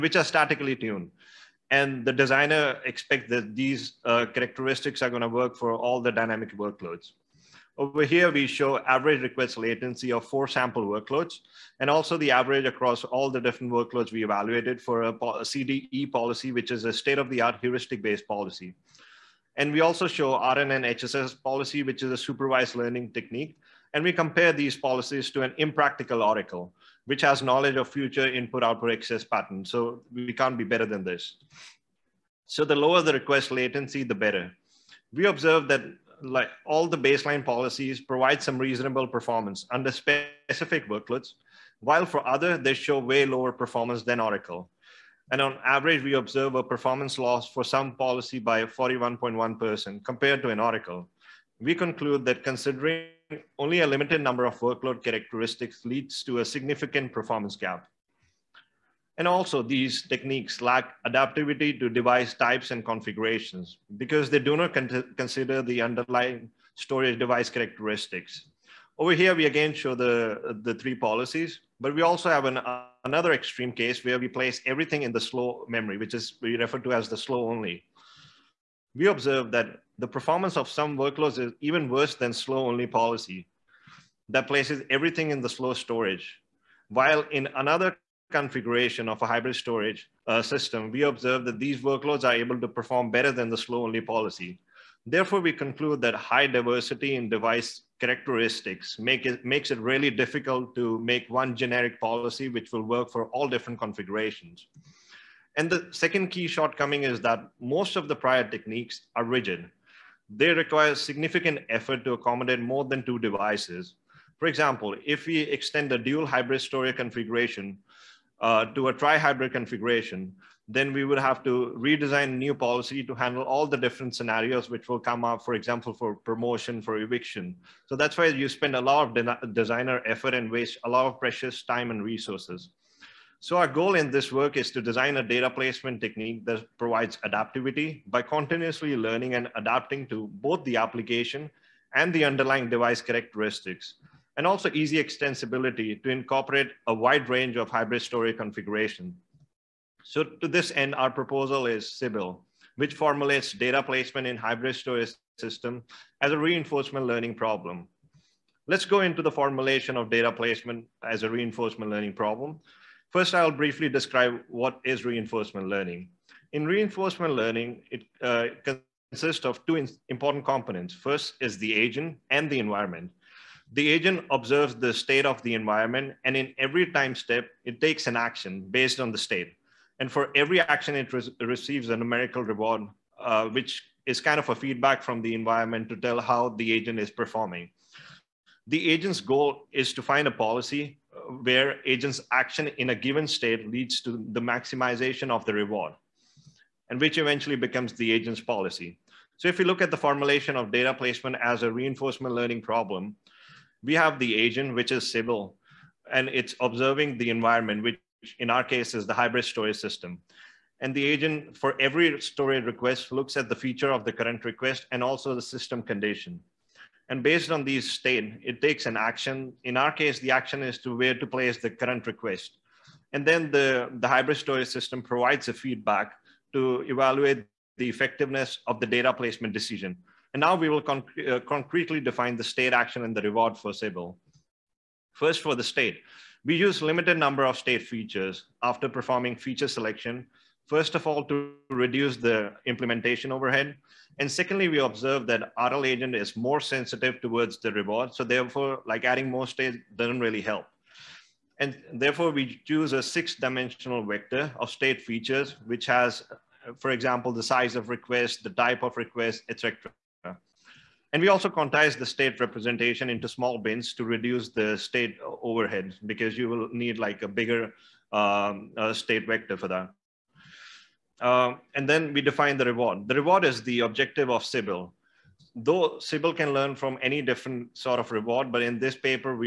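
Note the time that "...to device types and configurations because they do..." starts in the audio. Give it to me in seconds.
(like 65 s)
61 s.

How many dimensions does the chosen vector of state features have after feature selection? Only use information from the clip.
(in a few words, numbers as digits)
6.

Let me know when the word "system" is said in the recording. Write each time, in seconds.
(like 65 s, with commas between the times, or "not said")
90 s, 155 s, 209 s, 215 s, 224 s.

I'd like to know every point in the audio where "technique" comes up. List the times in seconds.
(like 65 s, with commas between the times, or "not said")
23 s, 60 s, 108 s, 136 s.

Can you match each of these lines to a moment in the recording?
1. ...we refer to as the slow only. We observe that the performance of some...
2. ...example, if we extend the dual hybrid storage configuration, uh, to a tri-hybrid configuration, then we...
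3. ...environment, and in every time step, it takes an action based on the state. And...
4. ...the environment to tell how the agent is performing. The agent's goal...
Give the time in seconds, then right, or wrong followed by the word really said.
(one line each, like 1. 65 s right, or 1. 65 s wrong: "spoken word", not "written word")
1. 76 s right
2. 114 s right
3. 175 s right
4. 185 s right.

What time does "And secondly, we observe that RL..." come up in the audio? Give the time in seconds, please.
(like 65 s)
244 s.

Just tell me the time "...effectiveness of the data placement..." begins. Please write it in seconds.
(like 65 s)
227 s.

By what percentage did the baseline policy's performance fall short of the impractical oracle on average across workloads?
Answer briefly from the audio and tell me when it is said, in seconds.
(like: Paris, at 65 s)
41.1%, at 48 s.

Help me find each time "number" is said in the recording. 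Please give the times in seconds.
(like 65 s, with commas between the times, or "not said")
54 s, 237 s.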